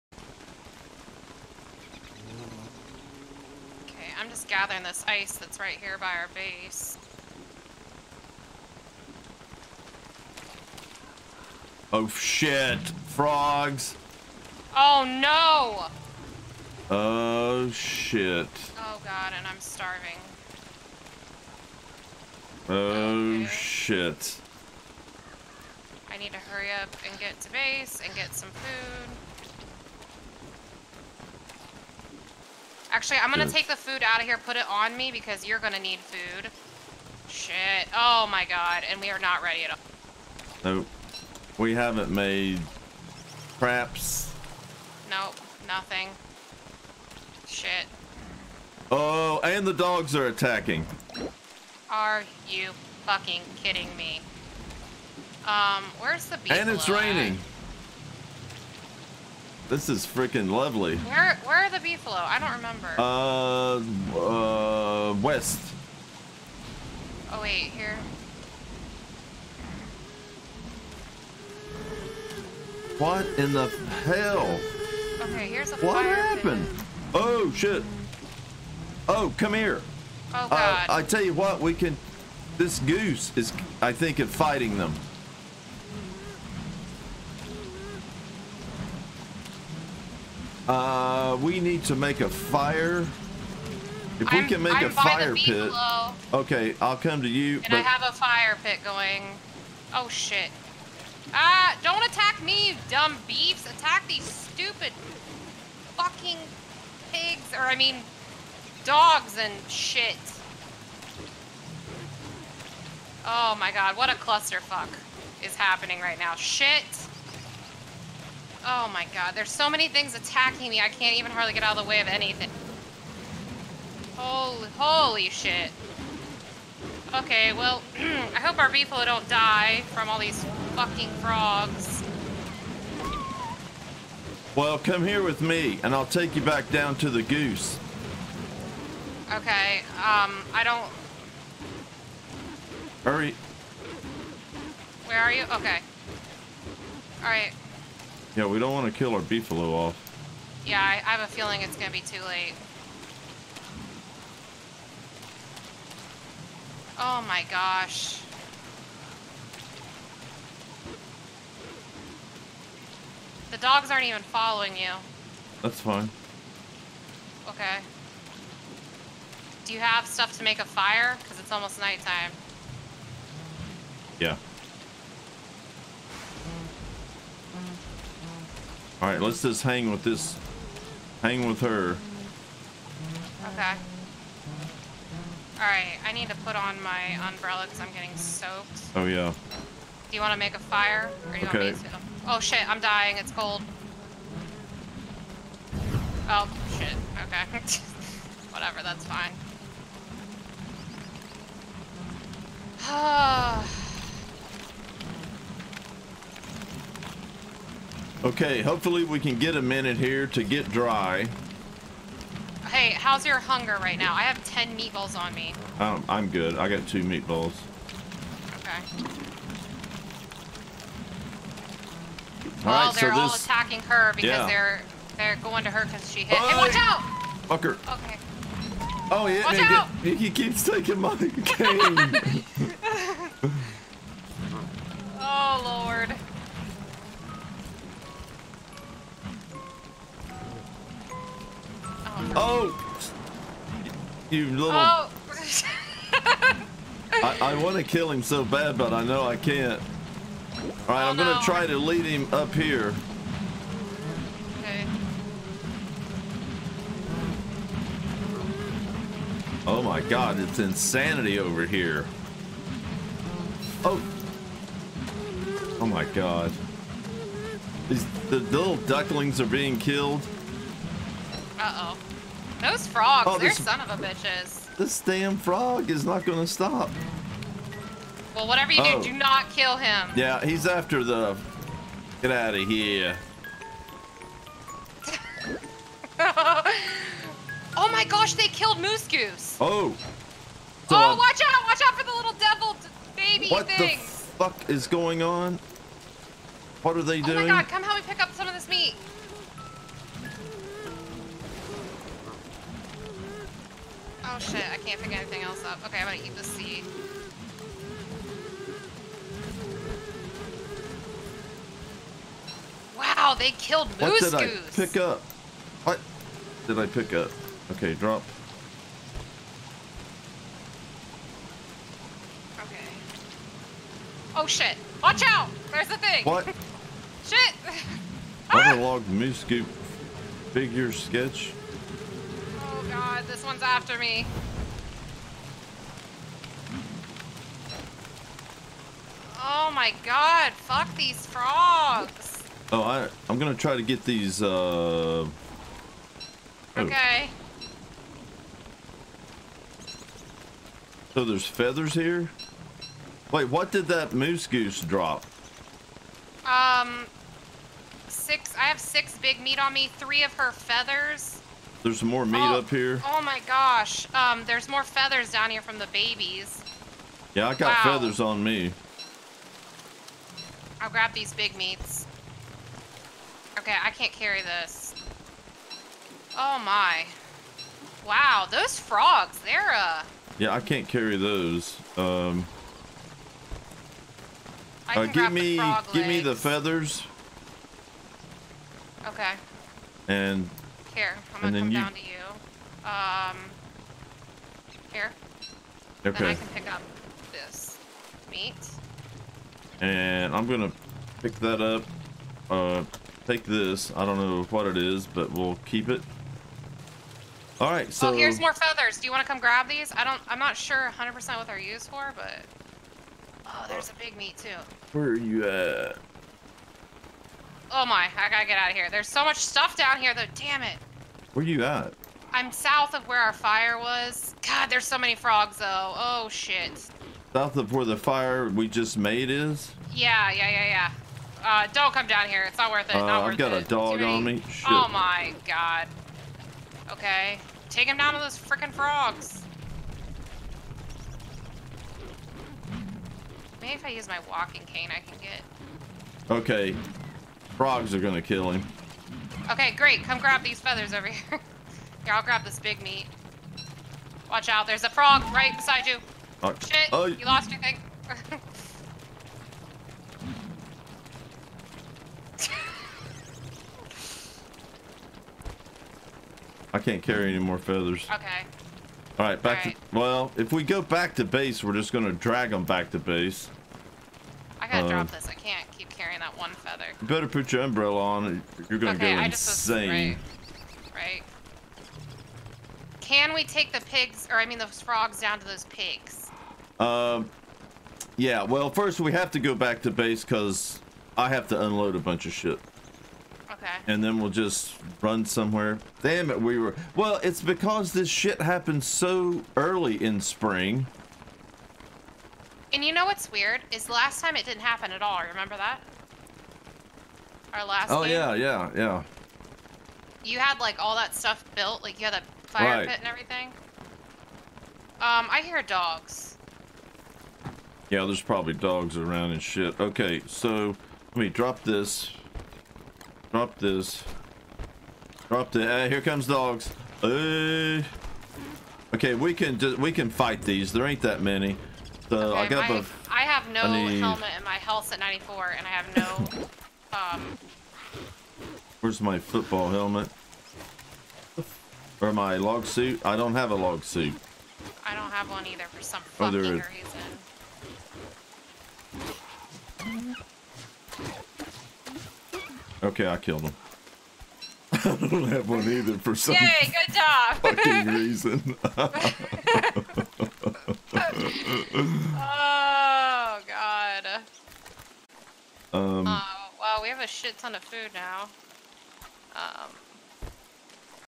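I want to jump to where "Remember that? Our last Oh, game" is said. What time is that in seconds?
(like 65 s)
505 s.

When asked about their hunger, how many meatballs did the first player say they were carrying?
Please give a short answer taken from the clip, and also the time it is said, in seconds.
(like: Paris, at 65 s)
10, at 214 s.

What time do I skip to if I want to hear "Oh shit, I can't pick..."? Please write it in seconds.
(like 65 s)
304 s.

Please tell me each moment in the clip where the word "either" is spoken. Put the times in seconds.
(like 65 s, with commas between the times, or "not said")
545 s, 555 s.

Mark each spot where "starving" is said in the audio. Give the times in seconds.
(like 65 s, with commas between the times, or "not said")
19 s.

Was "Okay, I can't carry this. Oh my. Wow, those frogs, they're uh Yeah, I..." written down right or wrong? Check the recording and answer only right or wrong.
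right.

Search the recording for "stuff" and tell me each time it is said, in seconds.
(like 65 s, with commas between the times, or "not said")
170 s, 419 s, 511 s.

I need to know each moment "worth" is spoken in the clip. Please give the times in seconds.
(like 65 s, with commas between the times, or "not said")
432 s.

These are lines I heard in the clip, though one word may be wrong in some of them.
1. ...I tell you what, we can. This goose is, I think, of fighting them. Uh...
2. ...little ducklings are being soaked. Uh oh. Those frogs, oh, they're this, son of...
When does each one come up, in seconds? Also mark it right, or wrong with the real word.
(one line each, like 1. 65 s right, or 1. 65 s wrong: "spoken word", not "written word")
1. 80 s right
2. 268 s wrong: "killed", not "soaked".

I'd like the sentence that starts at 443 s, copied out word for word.
Maybe if I use my walking cane, I can get.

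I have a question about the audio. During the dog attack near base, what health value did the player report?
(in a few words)
94.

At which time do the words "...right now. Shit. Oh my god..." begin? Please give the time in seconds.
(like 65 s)
115 s.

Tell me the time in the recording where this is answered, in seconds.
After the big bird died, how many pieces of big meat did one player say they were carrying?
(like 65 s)
358 s.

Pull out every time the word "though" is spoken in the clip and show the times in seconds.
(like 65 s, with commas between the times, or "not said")
420 s, 425 s.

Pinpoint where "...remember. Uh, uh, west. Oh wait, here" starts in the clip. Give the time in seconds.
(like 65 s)
62 s.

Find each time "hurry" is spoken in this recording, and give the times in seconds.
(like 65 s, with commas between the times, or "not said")
26 s, 143 s.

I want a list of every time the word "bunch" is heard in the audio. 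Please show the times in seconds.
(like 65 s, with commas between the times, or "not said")
491 s.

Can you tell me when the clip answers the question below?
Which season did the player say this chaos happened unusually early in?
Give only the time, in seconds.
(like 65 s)
500 s.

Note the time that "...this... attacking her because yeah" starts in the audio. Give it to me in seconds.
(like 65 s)
223 s.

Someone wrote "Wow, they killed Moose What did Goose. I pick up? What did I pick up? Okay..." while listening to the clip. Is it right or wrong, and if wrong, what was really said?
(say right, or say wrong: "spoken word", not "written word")
right.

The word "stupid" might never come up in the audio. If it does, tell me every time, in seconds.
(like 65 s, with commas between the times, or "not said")
104 s.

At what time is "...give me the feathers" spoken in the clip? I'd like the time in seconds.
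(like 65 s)
385 s.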